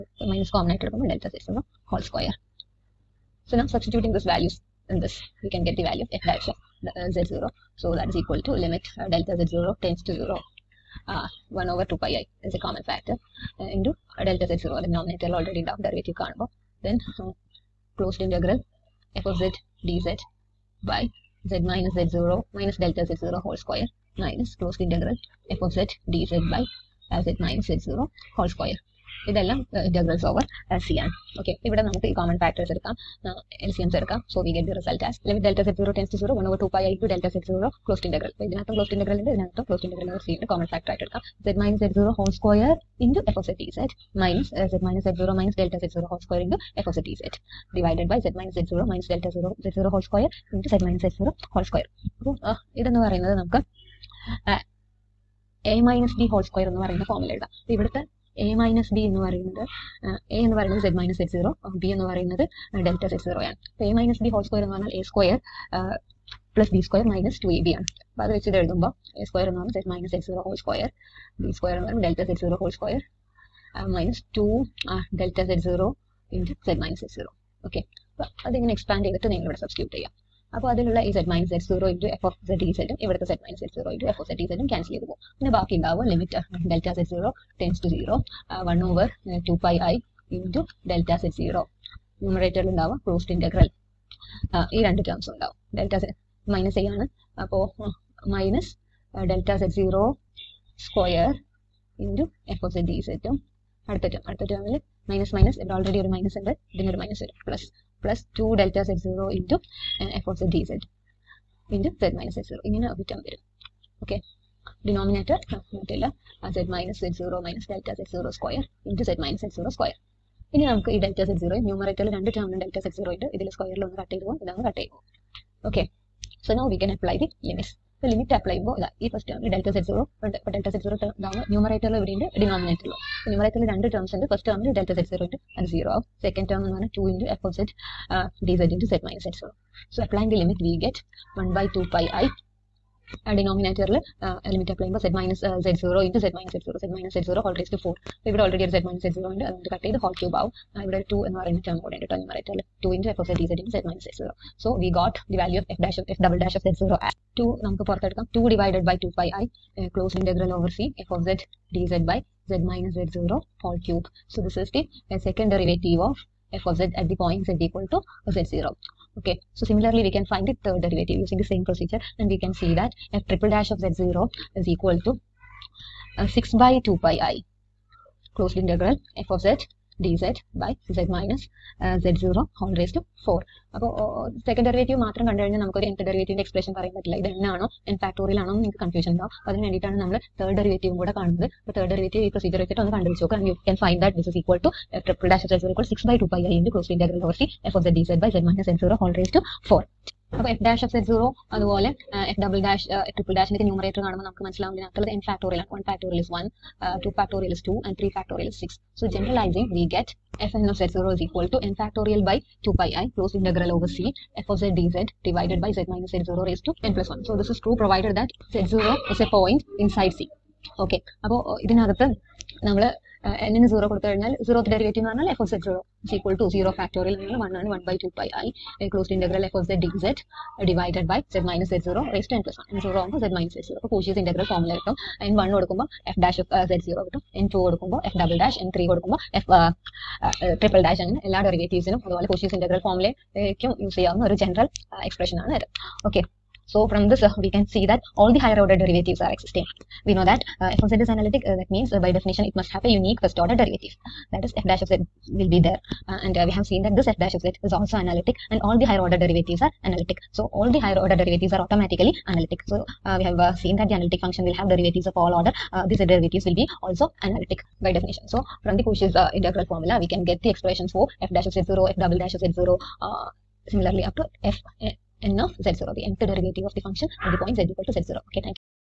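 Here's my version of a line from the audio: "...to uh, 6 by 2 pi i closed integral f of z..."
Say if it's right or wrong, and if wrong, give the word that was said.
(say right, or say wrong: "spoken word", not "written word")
right.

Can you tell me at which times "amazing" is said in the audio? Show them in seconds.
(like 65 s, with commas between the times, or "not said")
not said.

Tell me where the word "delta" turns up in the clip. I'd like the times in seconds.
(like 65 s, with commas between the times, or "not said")
1 s, 9 s, 14 s, 22 s, 49 s, 117 s.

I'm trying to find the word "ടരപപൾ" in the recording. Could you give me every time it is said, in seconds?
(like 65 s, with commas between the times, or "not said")
195 s, 203 s, 240 s.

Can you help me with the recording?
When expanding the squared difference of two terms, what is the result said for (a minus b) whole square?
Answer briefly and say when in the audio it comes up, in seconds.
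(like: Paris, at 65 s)
a² + b² − 2ab, at 64 s.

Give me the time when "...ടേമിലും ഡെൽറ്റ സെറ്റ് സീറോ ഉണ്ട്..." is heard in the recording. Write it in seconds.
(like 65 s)
122 s.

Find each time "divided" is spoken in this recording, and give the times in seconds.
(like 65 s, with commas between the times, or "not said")
47 s, 215 s.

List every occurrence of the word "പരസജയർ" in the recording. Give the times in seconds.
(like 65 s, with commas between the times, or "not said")
192 s.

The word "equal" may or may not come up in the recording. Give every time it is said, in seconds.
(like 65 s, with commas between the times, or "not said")
8 s, 167 s, 174 s, 277 s.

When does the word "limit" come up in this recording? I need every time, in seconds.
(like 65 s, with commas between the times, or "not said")
8 s, 140 s.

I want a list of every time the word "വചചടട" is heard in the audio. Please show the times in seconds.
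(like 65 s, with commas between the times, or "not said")
192 s.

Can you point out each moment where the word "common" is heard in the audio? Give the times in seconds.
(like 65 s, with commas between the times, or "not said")
0 s, 12 s.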